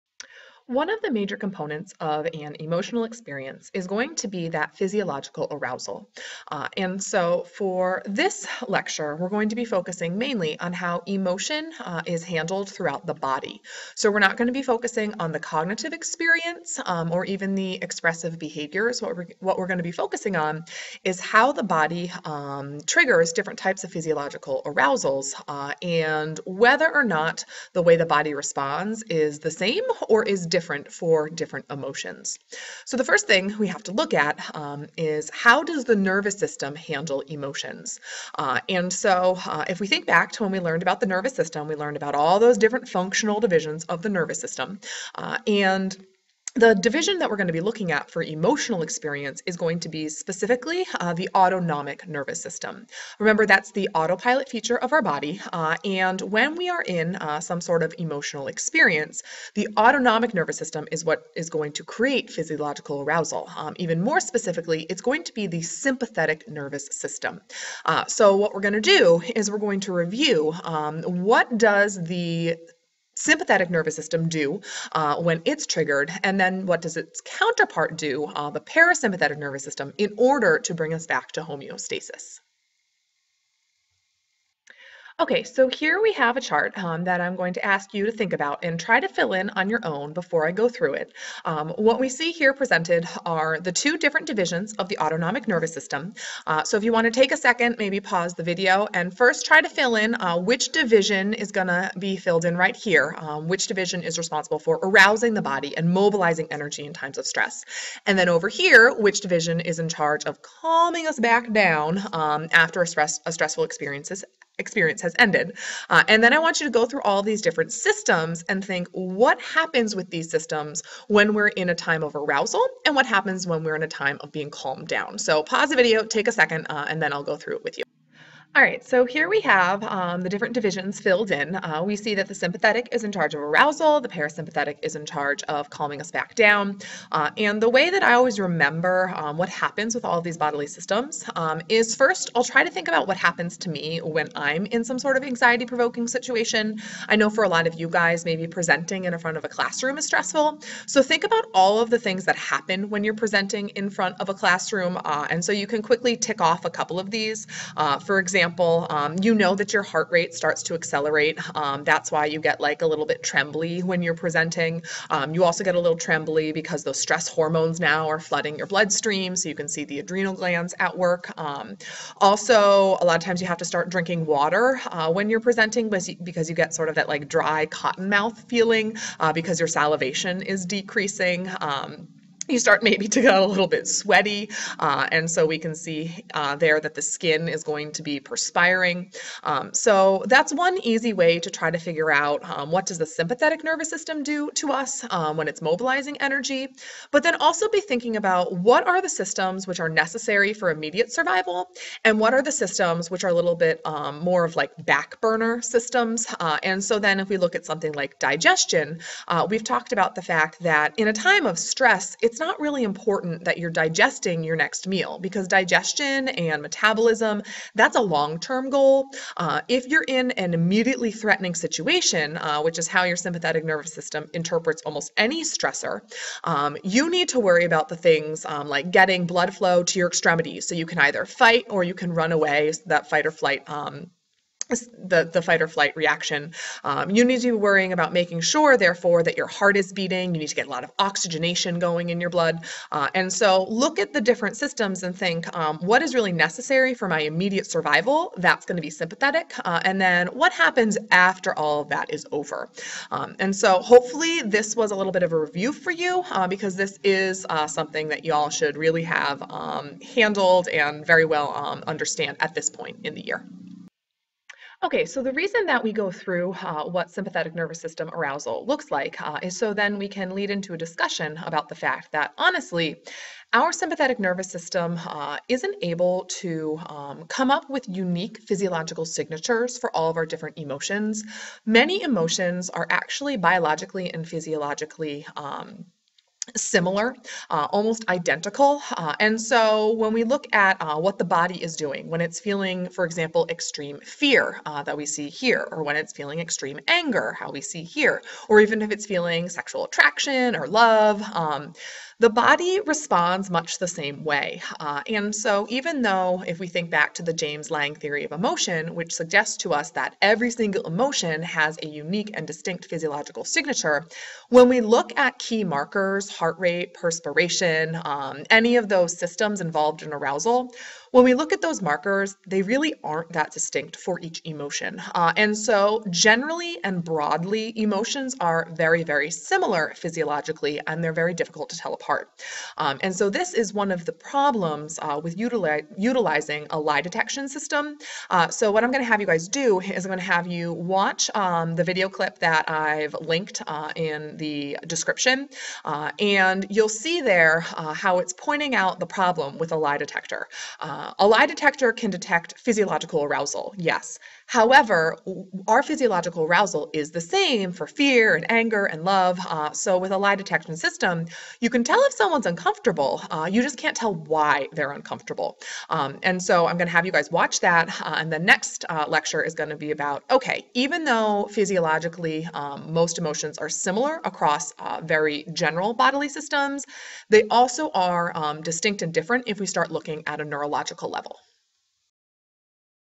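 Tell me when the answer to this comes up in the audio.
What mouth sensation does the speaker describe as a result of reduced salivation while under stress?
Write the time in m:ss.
2:57.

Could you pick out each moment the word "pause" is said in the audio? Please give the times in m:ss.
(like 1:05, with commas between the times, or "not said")
1:37, 2:05.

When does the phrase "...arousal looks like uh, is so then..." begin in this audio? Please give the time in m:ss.
4:28.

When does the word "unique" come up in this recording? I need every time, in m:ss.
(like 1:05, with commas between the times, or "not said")
4:37, 5:11.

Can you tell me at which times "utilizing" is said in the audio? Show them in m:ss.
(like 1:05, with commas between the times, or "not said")
5:35.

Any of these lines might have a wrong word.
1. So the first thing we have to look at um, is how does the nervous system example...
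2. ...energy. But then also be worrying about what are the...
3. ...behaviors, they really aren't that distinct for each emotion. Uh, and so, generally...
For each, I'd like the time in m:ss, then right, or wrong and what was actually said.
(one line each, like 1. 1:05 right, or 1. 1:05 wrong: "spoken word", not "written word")
1. 0:32 wrong: "handle", not "example"
2. 3:16 wrong: "thinking", not "worrying"
3. 5:21 wrong: "markers", not "behaviors".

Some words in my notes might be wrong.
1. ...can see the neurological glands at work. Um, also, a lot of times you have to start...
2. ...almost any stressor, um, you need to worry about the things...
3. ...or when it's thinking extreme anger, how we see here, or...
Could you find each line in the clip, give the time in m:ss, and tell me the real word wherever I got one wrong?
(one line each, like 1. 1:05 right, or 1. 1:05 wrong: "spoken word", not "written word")
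1. 2:49 wrong: "adrenal", not "neurological"
2. 3:44 right
3. 4:55 wrong: "feeling", not "thinking".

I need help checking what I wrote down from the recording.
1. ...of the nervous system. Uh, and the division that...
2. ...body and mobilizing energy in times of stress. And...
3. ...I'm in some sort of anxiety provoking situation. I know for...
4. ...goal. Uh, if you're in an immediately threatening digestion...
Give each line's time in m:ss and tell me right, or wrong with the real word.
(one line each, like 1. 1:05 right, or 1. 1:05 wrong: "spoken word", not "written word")
1. 0:43 right
2. 1:45 right
3. 2:24 right
4. 3:38 wrong: "situation", not "digestion".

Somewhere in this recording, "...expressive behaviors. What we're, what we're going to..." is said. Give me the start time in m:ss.
0:17.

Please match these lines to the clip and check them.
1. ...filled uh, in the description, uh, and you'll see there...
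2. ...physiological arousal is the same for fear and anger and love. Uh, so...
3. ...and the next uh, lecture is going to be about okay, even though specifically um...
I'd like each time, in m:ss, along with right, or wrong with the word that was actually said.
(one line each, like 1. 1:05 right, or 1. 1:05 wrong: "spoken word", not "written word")
1. 5:43 wrong: "linked", not "filled"
2. 5:55 right
3. 6:08 wrong: "physiologically", not "specifically".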